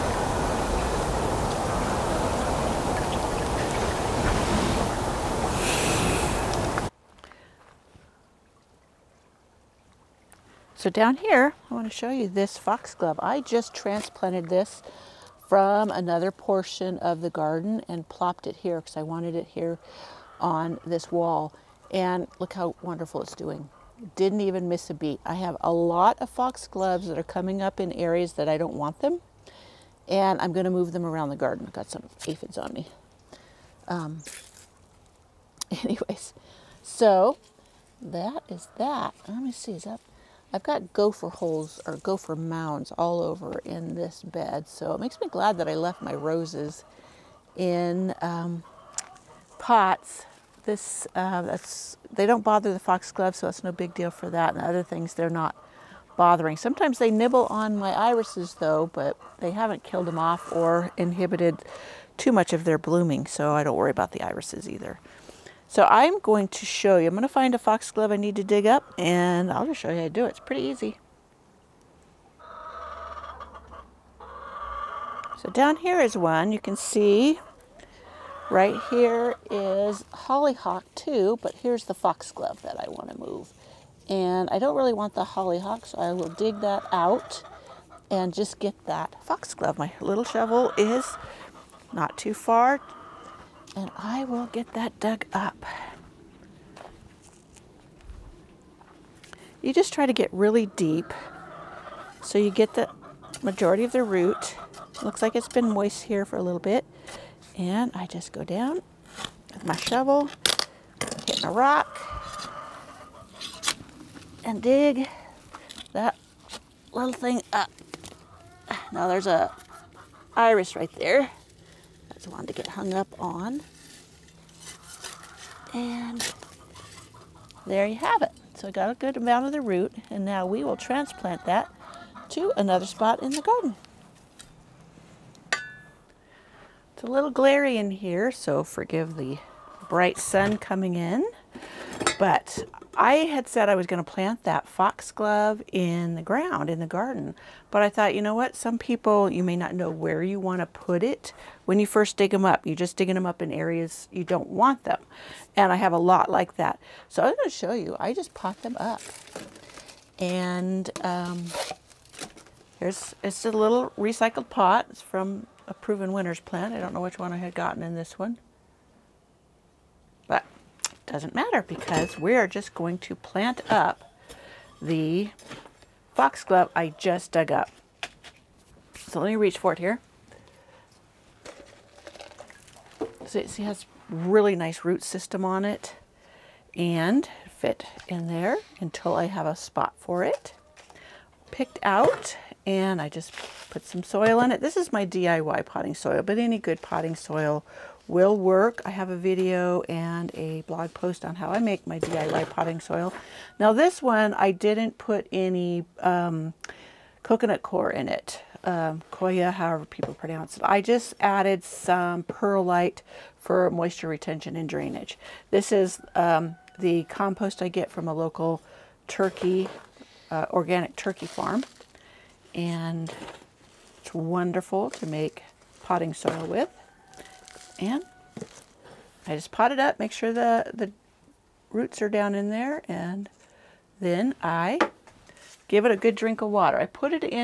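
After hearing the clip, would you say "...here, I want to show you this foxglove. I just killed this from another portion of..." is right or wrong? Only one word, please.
wrong.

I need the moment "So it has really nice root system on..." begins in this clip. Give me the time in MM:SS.
03:03.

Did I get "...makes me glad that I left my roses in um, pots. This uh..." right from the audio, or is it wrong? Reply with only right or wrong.
right.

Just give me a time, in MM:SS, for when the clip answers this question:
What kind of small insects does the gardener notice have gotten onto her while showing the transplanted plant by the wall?
00:32.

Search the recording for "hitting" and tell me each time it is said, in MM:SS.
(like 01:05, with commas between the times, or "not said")
01:51.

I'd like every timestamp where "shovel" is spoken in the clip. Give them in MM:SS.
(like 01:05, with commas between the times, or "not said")
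01:30, 01:49.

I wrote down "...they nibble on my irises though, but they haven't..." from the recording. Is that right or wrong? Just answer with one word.
right.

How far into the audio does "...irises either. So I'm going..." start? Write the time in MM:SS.
01:04.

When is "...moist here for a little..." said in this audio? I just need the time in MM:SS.
01:45.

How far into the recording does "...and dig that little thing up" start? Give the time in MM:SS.
01:54.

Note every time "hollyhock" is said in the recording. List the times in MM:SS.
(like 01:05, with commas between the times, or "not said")
01:20, 01:25.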